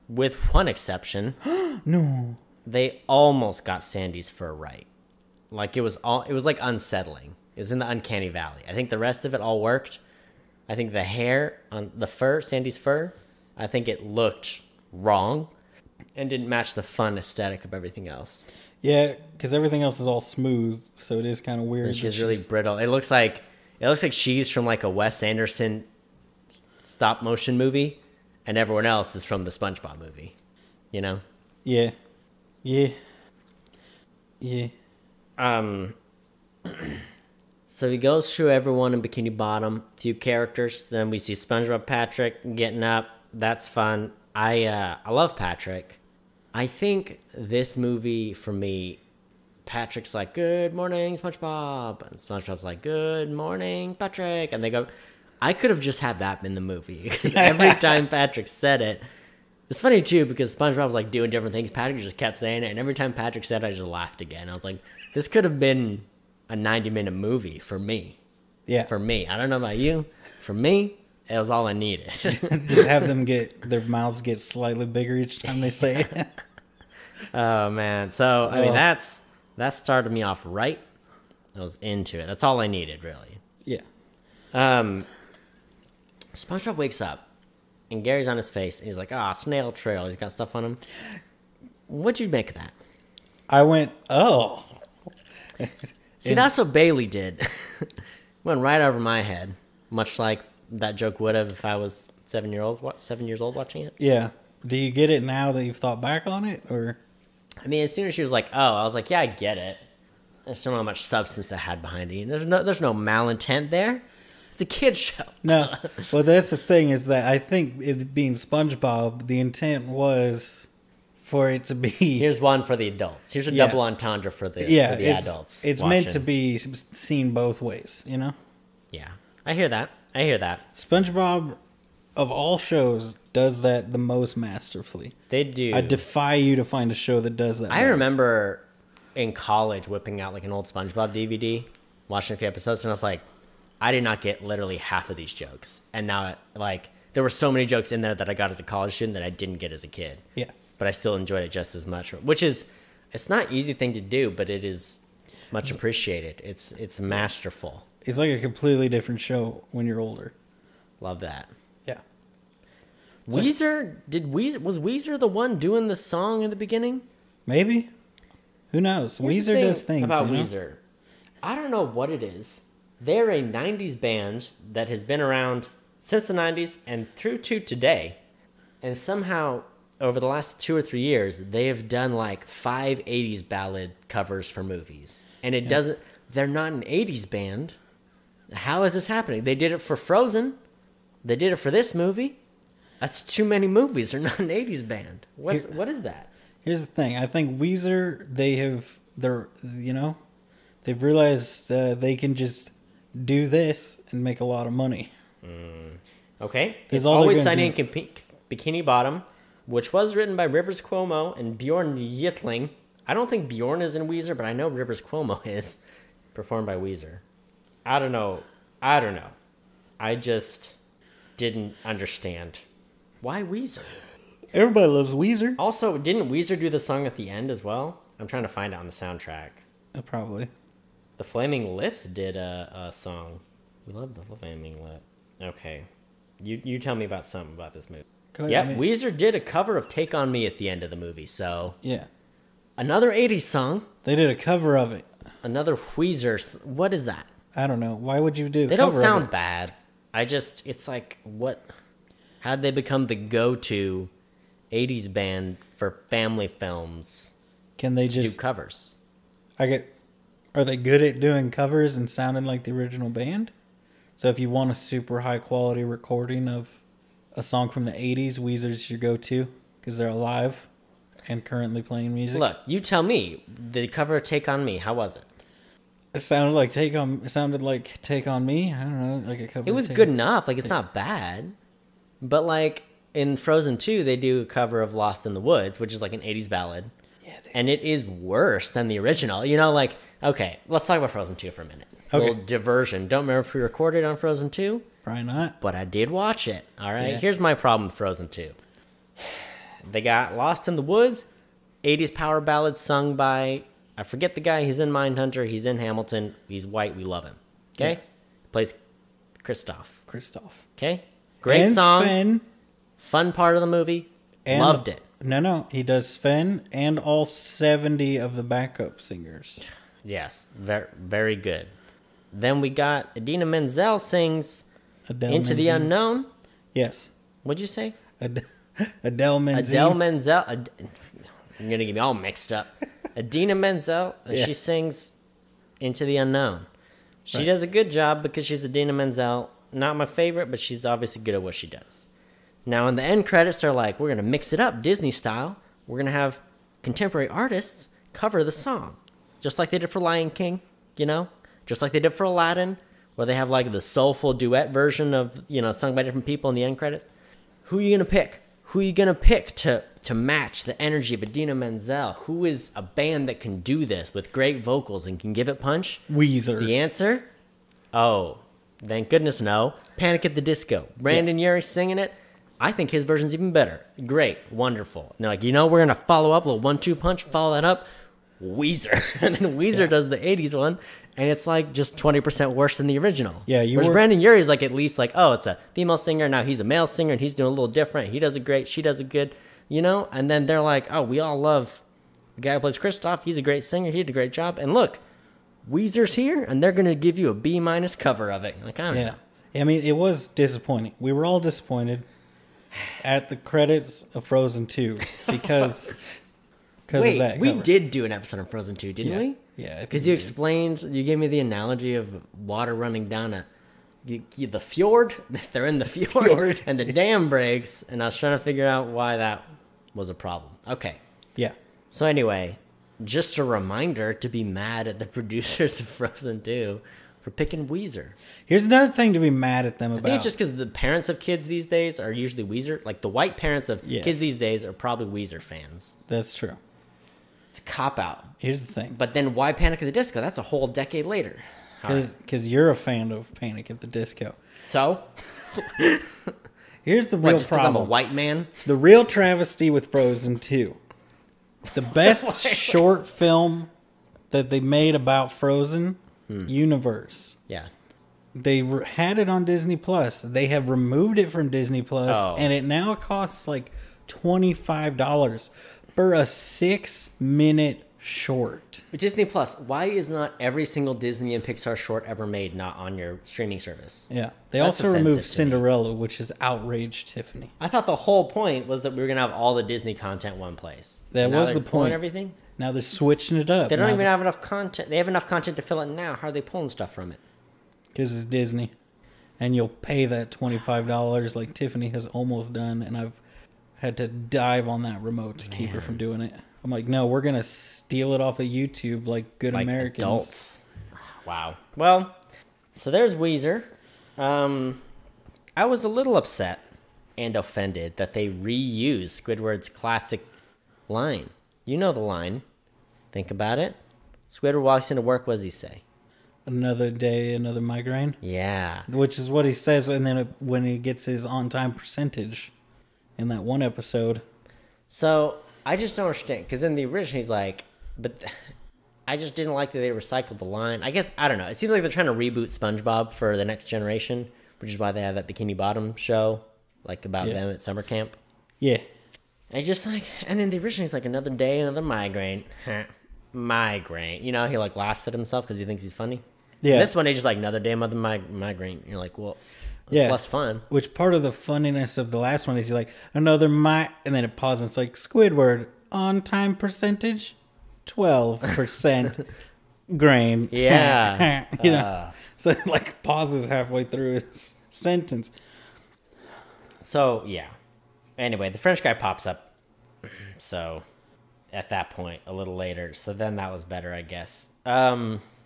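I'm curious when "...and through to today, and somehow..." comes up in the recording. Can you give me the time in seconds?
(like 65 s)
176 s.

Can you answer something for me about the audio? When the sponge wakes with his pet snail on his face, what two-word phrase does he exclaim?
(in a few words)
snail trail.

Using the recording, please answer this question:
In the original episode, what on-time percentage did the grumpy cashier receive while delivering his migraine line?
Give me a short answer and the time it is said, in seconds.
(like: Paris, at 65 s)
12%, at 557 s.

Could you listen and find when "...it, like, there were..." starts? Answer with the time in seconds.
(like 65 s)
146 s.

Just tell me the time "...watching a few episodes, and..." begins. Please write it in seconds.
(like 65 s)
142 s.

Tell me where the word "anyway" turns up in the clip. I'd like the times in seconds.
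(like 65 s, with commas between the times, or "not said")
422 s, 568 s.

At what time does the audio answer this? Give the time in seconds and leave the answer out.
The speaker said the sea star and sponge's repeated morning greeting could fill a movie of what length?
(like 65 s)
66 s.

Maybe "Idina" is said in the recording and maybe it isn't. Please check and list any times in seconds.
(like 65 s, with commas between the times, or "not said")
323 s, 333 s, 338 s, 361 s.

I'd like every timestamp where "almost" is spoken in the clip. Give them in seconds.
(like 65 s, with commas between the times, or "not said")
3 s, 492 s.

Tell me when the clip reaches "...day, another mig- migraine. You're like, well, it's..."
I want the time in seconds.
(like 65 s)
547 s.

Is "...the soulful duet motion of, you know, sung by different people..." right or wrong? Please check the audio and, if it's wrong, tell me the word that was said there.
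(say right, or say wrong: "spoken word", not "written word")
wrong: "version", not "motion".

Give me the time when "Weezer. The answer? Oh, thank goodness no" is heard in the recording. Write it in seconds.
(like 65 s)
366 s.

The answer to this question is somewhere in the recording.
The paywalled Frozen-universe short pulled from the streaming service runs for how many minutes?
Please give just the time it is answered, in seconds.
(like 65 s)
466 s.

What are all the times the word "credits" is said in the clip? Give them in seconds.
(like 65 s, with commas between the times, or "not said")
343 s, 356 s, 403 s.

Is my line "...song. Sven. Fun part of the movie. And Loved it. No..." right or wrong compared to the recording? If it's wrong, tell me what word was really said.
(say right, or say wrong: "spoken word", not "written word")
right.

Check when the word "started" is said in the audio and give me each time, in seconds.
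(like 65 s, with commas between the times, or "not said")
79 s.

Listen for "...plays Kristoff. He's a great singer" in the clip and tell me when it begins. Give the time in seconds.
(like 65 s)
392 s.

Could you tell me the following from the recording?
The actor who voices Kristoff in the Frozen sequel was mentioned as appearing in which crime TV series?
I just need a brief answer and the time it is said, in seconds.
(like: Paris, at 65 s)
Mindhunter, at 304 s.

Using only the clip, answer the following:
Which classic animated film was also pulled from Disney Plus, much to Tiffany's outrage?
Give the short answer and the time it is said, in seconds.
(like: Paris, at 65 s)
Cinderella, at 475 s.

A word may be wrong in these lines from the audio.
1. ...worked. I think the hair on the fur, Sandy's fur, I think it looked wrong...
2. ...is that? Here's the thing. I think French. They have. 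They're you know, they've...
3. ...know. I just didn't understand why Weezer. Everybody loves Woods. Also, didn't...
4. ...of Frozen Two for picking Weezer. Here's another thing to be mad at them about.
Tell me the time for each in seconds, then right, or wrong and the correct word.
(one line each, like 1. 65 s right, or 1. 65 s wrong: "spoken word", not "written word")
1. 9 s right
2. 195 s wrong: "Weezer", not "French"
3. 219 s wrong: "Weezer", not "Woods"
4. 425 s right.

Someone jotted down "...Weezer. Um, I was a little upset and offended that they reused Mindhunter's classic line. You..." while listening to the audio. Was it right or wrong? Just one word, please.
wrong.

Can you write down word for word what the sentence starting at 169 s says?
Here's Weezer thing does things about you know?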